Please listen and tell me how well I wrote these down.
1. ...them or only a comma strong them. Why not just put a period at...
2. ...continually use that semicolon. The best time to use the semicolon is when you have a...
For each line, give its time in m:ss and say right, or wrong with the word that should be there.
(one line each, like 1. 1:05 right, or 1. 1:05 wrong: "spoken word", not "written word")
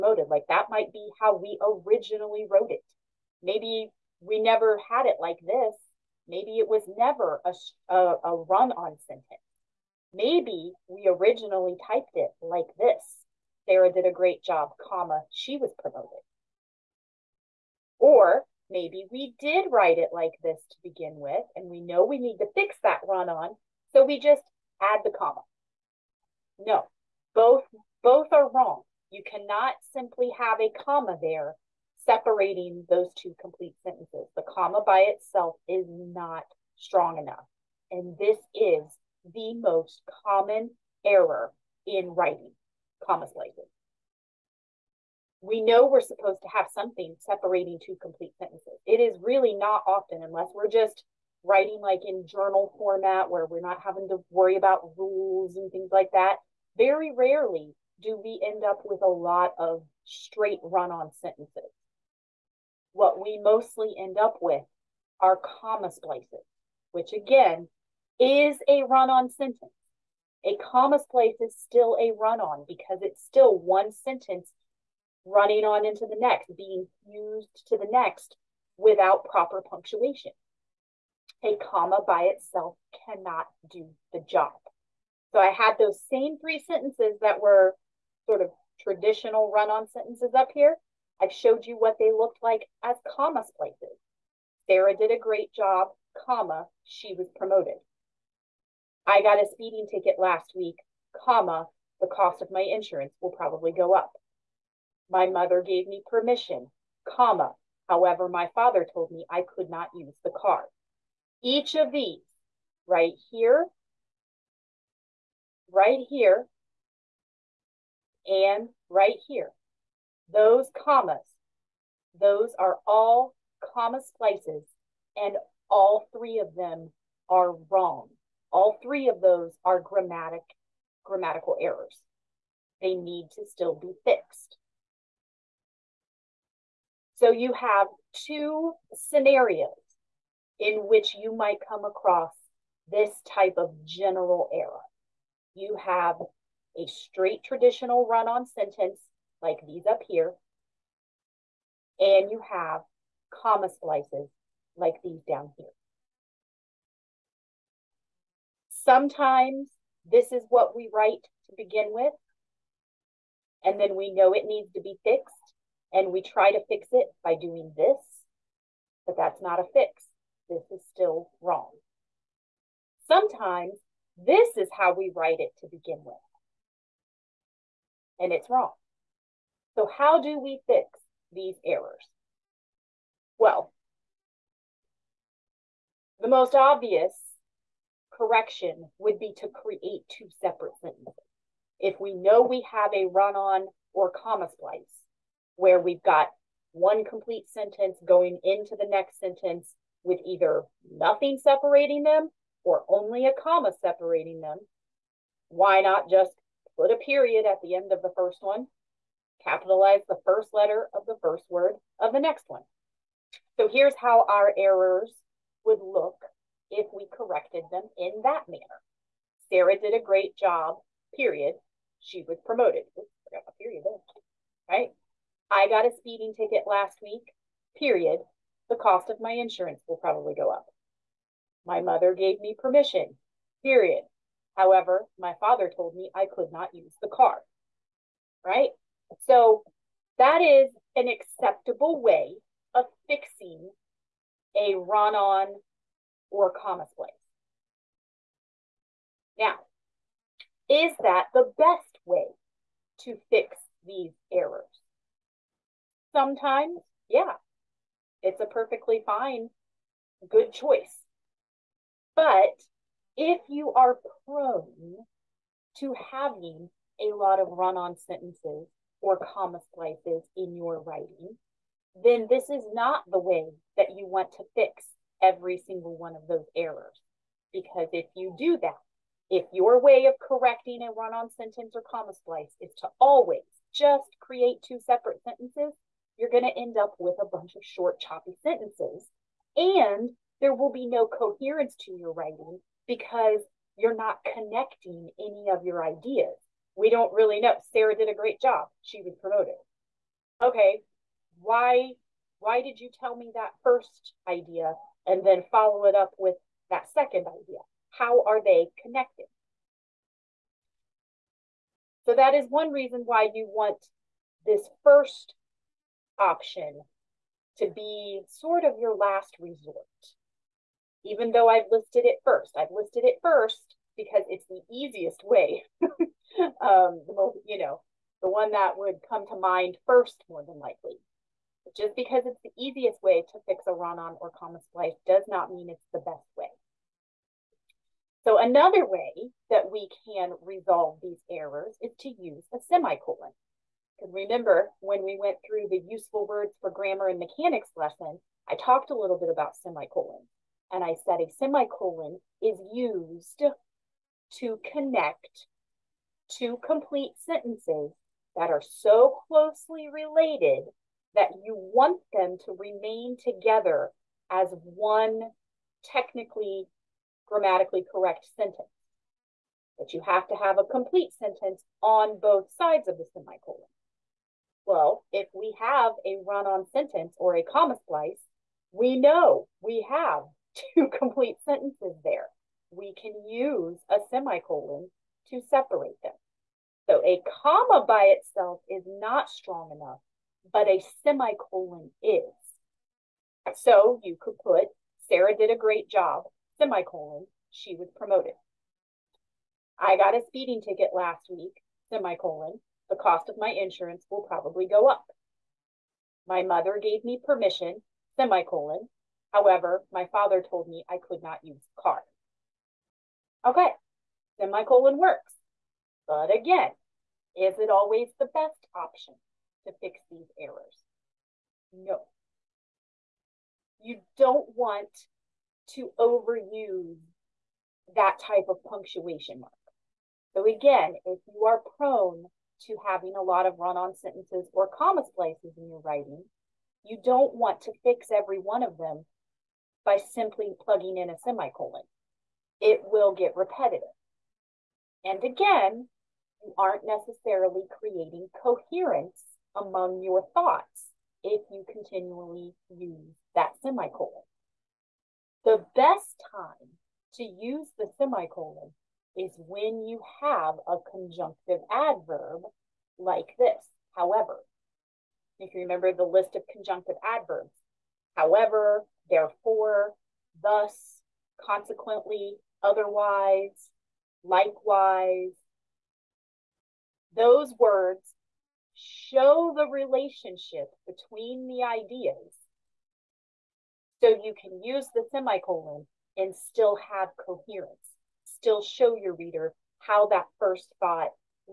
1. 3:22 wrong: "separating", not "strong"
2. 7:31 right.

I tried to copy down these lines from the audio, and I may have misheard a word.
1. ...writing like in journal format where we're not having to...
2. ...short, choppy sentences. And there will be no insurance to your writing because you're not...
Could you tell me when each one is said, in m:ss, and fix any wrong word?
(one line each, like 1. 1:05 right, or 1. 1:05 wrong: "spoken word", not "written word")
1. 0:51 right
2. 4:47 wrong: "coherence", not "insurance".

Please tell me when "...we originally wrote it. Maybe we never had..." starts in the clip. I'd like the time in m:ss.
0:01.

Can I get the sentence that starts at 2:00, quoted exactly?
Those commas, those are all comma splices, and all three of them are wrong.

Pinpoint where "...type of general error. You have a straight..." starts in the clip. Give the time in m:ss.
2:23.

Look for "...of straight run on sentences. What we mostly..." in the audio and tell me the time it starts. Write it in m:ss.
0:59.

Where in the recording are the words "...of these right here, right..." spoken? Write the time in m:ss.
1:51.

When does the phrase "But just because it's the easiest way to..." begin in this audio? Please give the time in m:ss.
5:31.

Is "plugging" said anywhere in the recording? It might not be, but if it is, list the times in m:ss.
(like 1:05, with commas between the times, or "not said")
7:20.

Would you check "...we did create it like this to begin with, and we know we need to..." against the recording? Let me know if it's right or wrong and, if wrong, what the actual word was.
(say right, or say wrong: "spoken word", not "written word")
wrong: "write", not "create".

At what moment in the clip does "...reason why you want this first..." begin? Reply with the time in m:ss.
5:12.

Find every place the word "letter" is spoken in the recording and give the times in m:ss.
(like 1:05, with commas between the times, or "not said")
3:30.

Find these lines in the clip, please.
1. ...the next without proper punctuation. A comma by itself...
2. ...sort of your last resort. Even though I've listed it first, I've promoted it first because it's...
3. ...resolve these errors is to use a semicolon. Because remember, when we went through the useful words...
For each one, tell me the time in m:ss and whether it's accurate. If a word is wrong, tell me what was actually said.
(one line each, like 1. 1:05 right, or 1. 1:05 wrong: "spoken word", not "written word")
1. 1:17 right
2. 5:18 wrong: "listed", not "promoted"
3. 5:40 right.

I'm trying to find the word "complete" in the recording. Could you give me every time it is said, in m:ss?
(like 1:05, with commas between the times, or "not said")
0:33, 0:48, 3:17, 5:56, 6:10, 6:20.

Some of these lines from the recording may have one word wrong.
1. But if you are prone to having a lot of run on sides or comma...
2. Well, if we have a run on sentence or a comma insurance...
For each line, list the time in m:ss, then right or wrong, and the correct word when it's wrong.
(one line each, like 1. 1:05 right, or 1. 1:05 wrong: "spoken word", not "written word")
1. 4:22 wrong: "sentences", not "sides"
2. 6:14 wrong: "splice", not "insurance".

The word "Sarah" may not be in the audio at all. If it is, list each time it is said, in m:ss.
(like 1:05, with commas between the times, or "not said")
0:13, 1:34, 3:39, 4:57, 6:35.